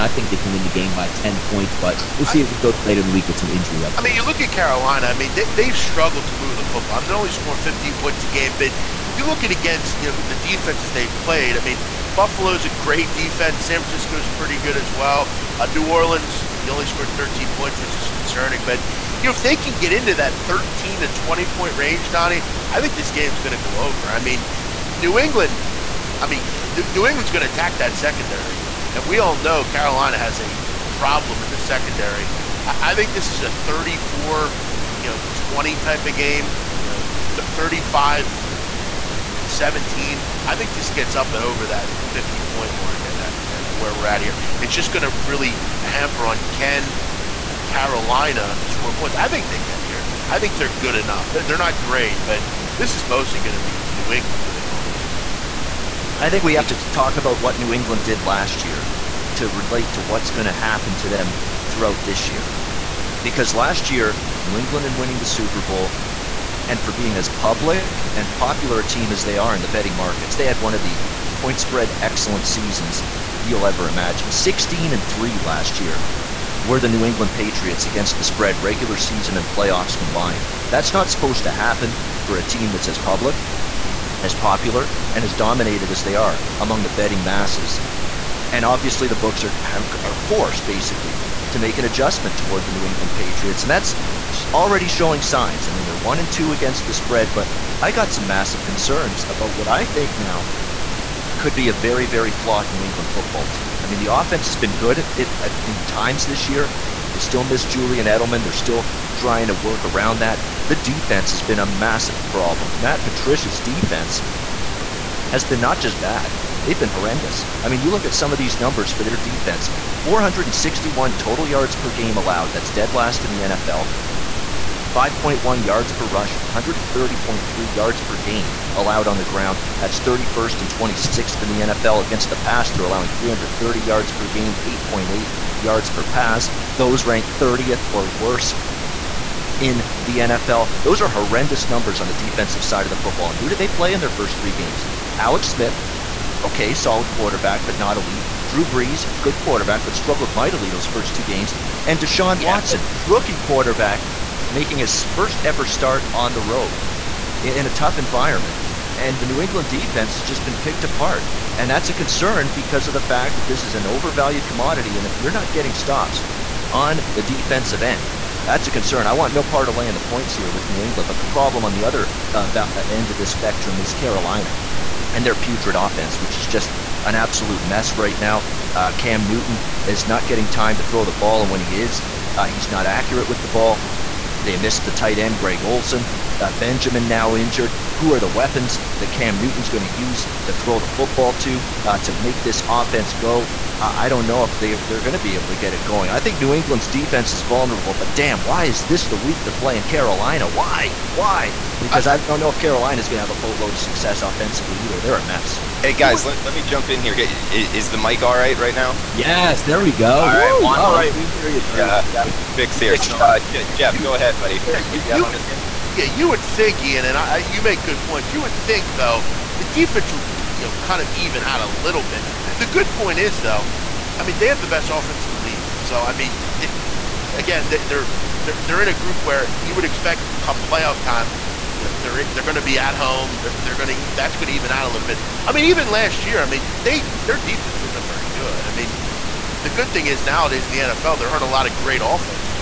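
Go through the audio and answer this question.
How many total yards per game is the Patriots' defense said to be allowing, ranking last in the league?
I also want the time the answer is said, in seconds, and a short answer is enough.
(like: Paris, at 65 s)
461, at 120 s.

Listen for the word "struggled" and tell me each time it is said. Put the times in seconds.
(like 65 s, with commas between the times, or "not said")
5 s, 149 s.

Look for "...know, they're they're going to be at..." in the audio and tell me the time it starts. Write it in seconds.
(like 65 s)
231 s.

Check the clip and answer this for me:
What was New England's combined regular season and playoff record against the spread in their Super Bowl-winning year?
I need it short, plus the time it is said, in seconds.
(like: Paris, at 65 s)
16 and 3, at 74 s.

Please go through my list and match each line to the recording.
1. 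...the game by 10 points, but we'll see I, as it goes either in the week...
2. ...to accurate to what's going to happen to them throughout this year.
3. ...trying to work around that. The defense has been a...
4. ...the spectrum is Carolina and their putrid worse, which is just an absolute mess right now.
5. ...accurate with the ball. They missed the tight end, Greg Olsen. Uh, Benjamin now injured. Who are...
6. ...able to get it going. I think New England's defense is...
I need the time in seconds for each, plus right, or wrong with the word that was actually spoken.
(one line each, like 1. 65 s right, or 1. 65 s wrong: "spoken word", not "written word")
1. 0 s wrong: "later", not "either"
2. 59 s wrong: "relate", not "accurate"
3. 109 s right
4. 173 s wrong: "offense", not "worse"
5. 182 s right
6. 195 s right.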